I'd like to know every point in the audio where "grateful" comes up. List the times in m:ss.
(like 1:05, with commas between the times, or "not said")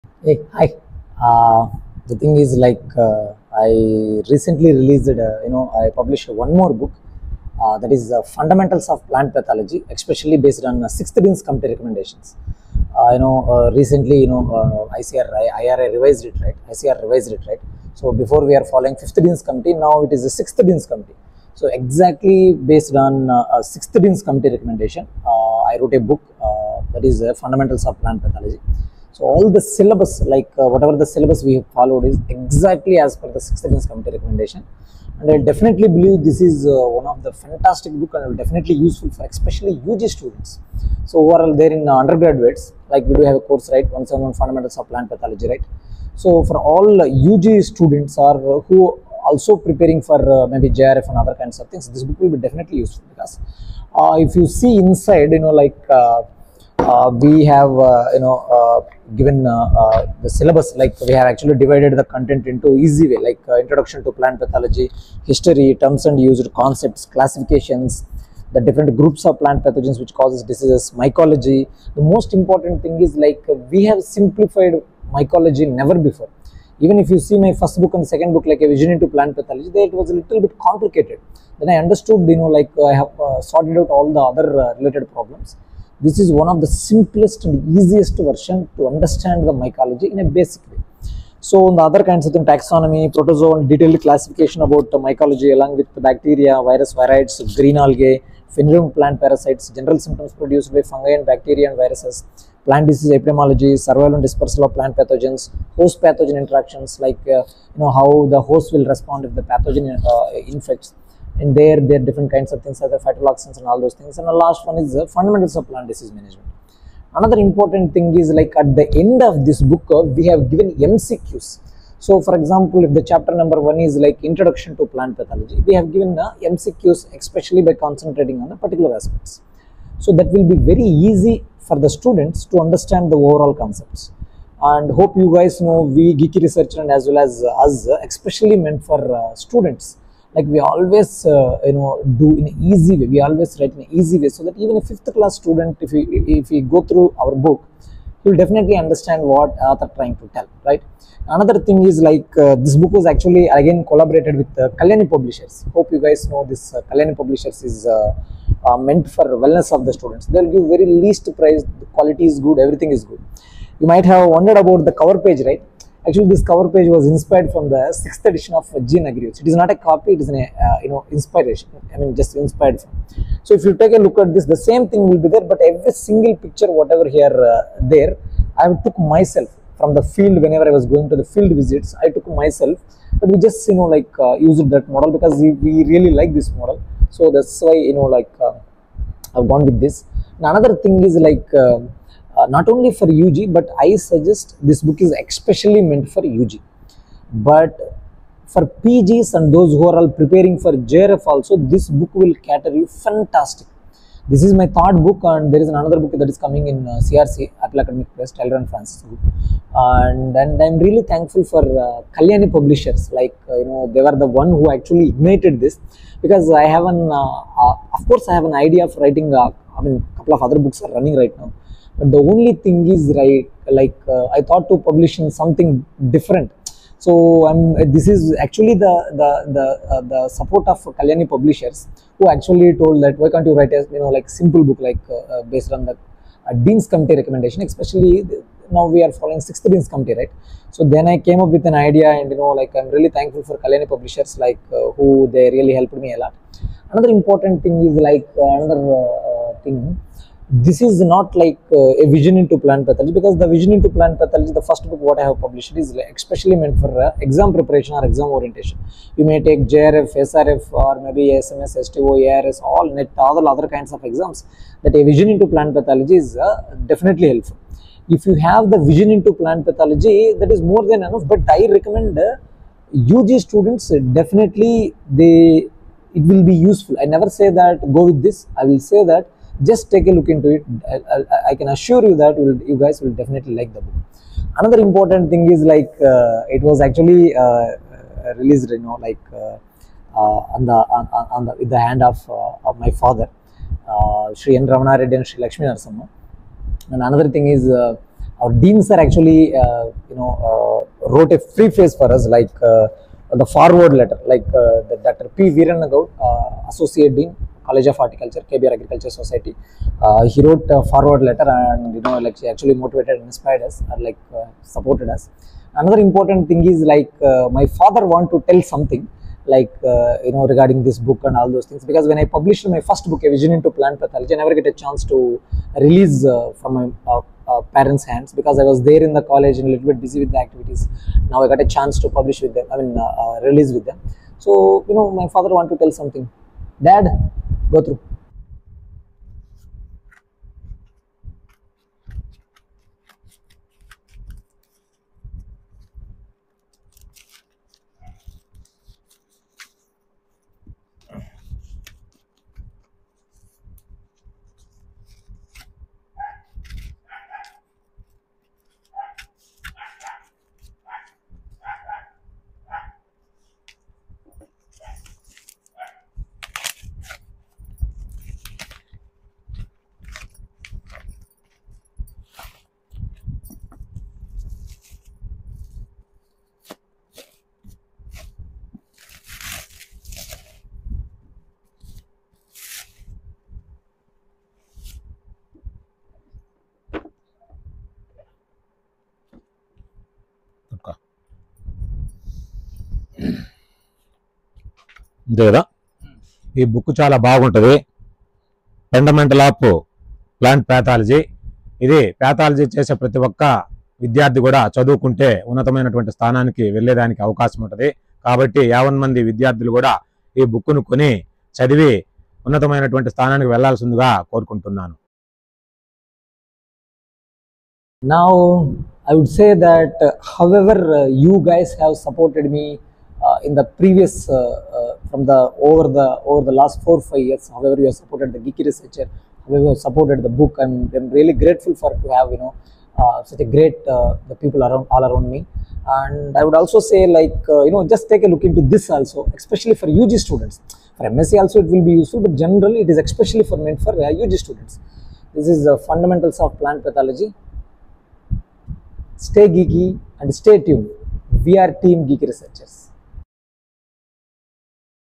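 7:11.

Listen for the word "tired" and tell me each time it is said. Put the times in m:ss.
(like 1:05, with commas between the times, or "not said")
not said.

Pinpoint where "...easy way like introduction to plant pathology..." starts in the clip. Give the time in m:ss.
1:02.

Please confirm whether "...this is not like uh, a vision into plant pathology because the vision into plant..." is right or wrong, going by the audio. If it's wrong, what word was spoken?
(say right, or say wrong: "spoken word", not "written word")
right.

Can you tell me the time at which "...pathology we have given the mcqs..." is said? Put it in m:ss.
2:05.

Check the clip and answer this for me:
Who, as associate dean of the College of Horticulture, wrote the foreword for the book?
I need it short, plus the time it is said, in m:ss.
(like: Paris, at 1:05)
Dr P Viranagaud, at 5:05.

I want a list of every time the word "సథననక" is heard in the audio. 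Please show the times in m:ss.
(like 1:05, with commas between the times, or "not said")
6:46, 6:53.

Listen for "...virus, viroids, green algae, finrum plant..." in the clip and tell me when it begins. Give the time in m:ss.
1:36.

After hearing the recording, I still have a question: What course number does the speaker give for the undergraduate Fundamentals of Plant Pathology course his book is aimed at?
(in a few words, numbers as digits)
171.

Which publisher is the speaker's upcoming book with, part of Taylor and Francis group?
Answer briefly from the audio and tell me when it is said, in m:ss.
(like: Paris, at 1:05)
CRC Apple Academic Press, at 3:27.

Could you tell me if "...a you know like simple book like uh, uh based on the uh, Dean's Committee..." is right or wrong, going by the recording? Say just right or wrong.
right.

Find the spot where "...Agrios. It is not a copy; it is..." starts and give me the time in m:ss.
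2:49.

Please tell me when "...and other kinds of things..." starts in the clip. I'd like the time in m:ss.
0:51.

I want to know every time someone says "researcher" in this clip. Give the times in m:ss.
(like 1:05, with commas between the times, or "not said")
2:16, 7:08, 7:32.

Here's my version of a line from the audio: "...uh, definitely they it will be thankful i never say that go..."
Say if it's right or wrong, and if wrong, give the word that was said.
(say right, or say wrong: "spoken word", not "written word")
wrong: "useful", not "thankful".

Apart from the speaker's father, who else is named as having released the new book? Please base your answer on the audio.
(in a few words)
Sri Lakshmi Narasimha.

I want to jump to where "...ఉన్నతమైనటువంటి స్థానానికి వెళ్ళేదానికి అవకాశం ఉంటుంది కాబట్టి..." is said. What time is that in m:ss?
6:45.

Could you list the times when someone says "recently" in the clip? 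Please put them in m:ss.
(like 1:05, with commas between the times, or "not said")
0:04, 0:13.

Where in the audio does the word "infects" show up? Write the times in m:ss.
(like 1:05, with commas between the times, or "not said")
1:50.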